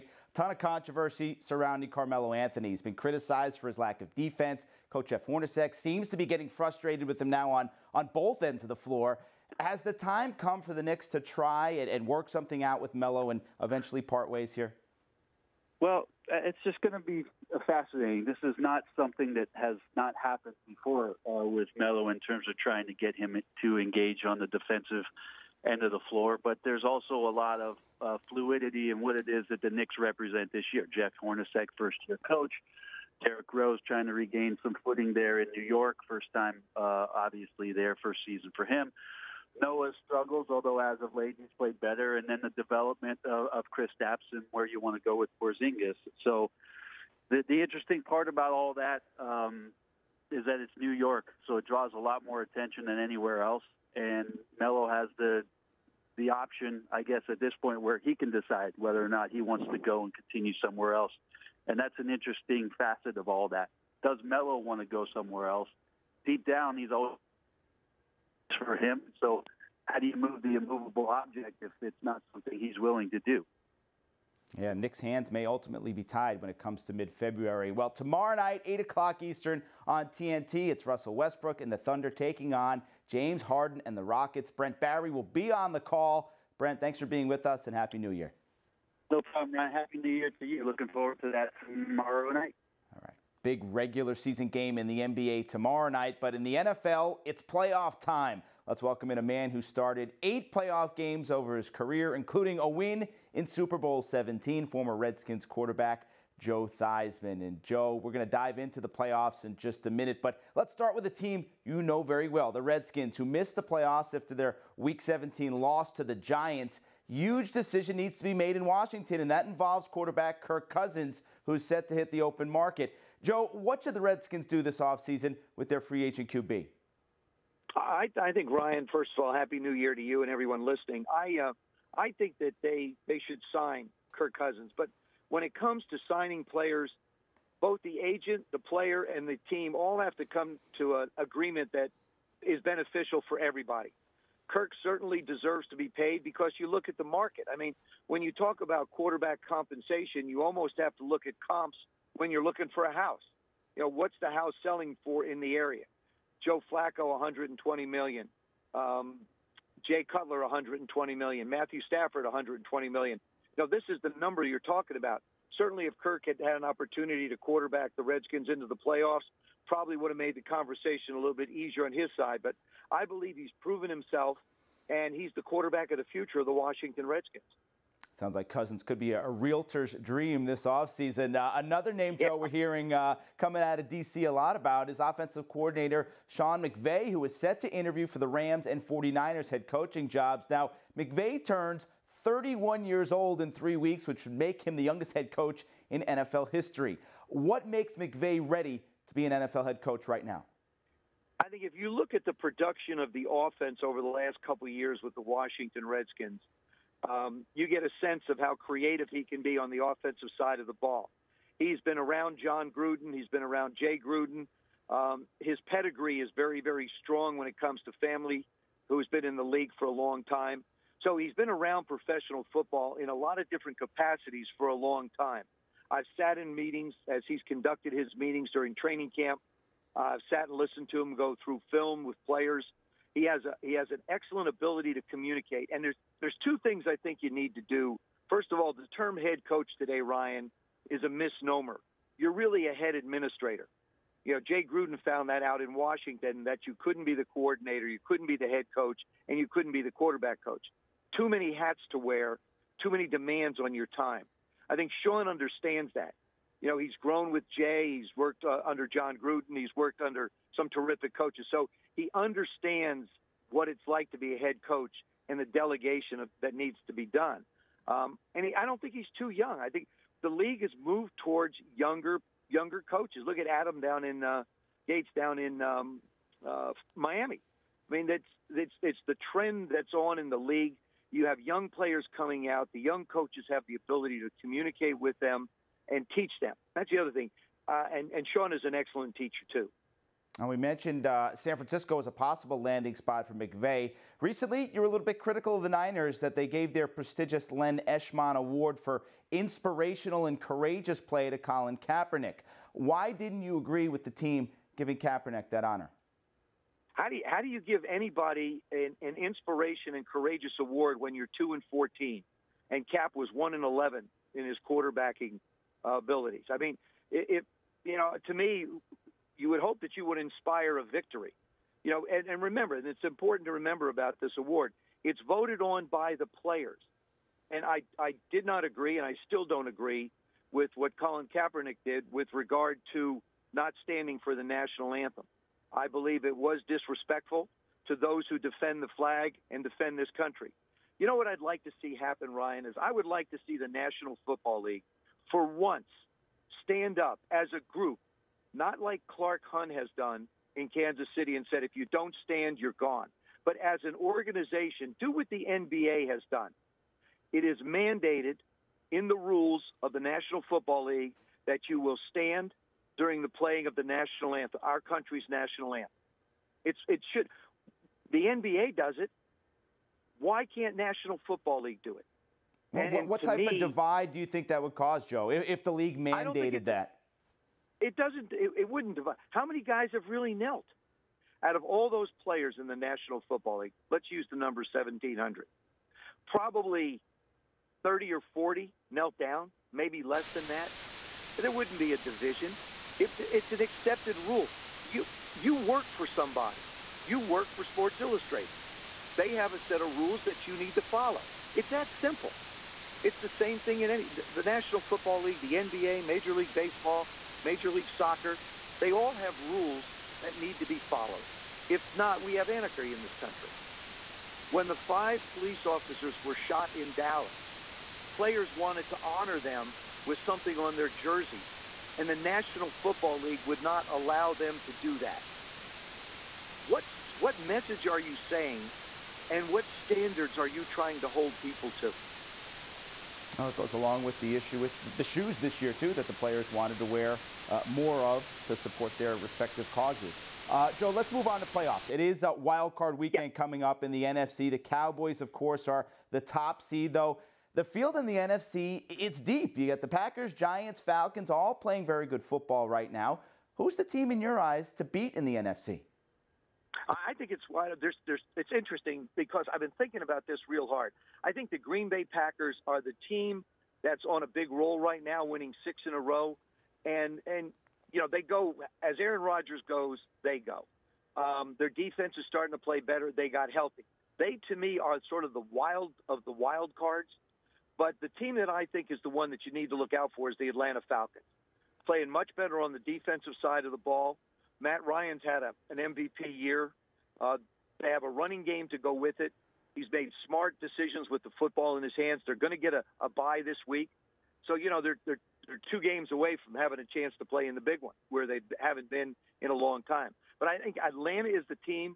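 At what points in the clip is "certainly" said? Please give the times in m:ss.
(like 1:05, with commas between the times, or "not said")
2:24, 2:45.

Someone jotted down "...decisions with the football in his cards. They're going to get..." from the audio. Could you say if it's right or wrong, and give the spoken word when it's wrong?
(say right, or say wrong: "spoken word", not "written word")
wrong: "hands", not "cards".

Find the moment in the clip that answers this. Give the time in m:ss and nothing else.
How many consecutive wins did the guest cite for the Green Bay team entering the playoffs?
7:45.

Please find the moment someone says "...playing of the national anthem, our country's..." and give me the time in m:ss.
6:03.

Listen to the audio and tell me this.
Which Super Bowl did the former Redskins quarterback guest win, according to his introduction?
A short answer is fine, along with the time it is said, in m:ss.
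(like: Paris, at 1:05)
Super Bowl 17, at 1:43.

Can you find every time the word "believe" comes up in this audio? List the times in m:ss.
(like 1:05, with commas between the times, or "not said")
2:53, 5:35.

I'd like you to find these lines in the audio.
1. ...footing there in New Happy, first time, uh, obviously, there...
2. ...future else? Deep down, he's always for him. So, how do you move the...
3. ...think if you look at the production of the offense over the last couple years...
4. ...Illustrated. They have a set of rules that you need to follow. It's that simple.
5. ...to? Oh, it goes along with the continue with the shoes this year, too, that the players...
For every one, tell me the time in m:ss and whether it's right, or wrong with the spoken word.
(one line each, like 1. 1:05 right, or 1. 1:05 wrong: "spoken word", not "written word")
1. 0:34 wrong: "York", not "Happy"
2. 1:05 wrong: "somewhere", not "future"
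3. 3:21 right
4. 6:37 right
5. 7:11 wrong: "issue", not "continue".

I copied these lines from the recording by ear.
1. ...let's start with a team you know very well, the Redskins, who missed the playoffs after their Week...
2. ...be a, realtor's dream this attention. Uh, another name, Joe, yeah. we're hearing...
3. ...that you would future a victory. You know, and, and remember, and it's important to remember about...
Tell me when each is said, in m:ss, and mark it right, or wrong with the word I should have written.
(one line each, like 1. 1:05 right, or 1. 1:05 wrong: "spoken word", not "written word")
1. 1:50 right
2. 2:58 wrong: "offseason", not "attention"
3. 5:19 wrong: "inspire", not "future".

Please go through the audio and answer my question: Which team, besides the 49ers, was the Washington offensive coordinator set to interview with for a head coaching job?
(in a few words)
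Rams.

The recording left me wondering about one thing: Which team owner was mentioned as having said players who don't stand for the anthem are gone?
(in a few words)
Clark Hunt.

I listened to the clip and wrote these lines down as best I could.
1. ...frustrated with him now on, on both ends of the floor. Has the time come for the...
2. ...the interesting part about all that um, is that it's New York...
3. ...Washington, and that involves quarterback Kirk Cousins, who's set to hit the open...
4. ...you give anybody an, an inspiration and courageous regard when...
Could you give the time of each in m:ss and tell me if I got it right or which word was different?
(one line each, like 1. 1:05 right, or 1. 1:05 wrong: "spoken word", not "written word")
1. 0:06 right
2. 0:47 right
3. 1:58 right
4. 5:07 wrong: "award", not "regard".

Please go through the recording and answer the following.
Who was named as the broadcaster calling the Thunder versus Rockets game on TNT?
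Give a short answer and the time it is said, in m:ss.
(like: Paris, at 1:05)
Brent Barry, at 1:24.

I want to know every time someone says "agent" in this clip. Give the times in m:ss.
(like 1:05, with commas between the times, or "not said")
2:06, 2:18.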